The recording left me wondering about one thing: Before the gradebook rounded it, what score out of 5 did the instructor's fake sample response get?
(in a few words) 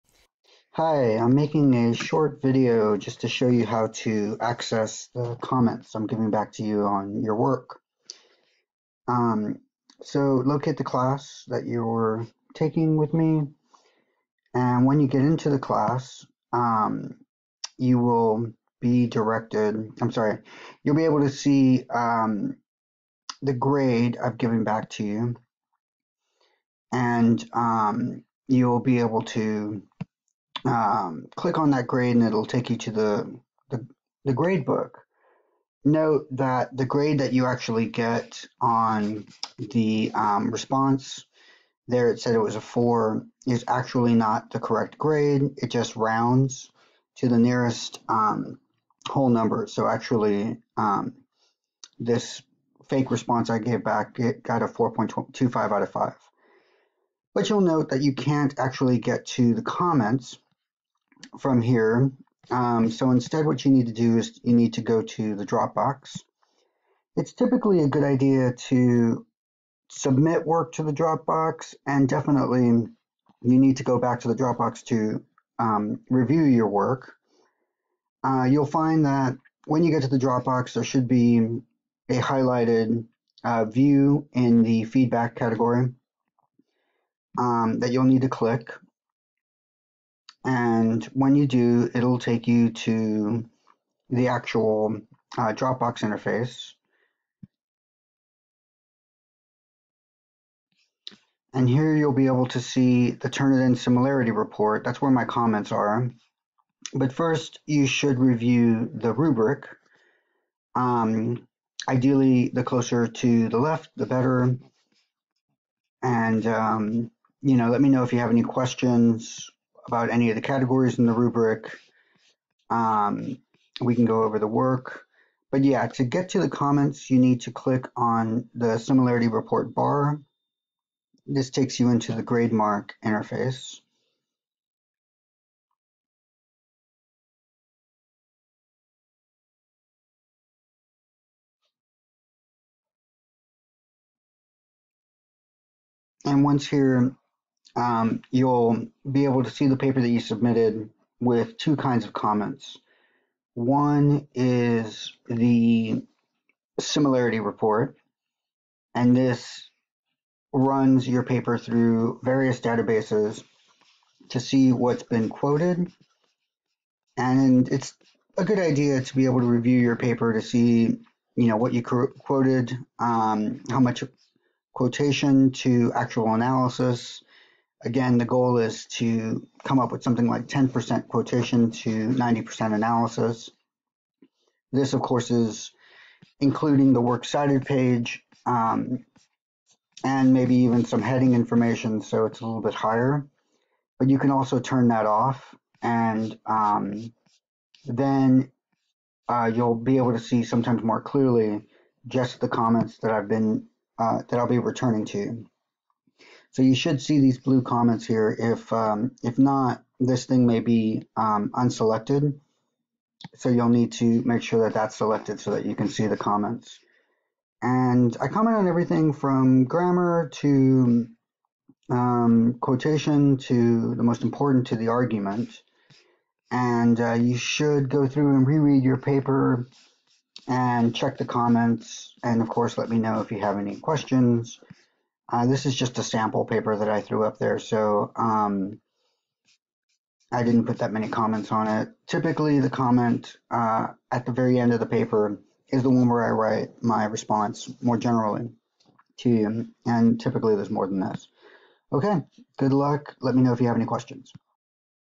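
4.25.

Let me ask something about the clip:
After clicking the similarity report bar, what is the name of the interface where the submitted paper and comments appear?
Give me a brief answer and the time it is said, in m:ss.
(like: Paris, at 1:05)
GradeMark, at 2:12.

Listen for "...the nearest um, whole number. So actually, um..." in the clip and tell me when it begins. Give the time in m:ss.
0:47.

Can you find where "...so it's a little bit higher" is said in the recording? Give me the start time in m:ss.
3:12.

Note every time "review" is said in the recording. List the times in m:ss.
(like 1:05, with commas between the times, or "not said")
1:16, 1:48, 2:49.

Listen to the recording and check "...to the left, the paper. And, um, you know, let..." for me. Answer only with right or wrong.
wrong.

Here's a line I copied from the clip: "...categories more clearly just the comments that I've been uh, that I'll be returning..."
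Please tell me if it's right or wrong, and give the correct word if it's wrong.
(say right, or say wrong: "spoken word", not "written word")
wrong: "sometimes", not "categories".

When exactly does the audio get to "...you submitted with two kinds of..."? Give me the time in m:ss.
2:30.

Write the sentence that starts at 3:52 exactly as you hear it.
And of course, let me know if you have any questions.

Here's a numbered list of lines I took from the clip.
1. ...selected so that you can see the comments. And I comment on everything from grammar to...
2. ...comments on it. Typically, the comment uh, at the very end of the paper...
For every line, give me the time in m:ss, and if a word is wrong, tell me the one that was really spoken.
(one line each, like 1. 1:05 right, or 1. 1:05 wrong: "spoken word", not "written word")
1. 3:34 right
2. 4:01 right.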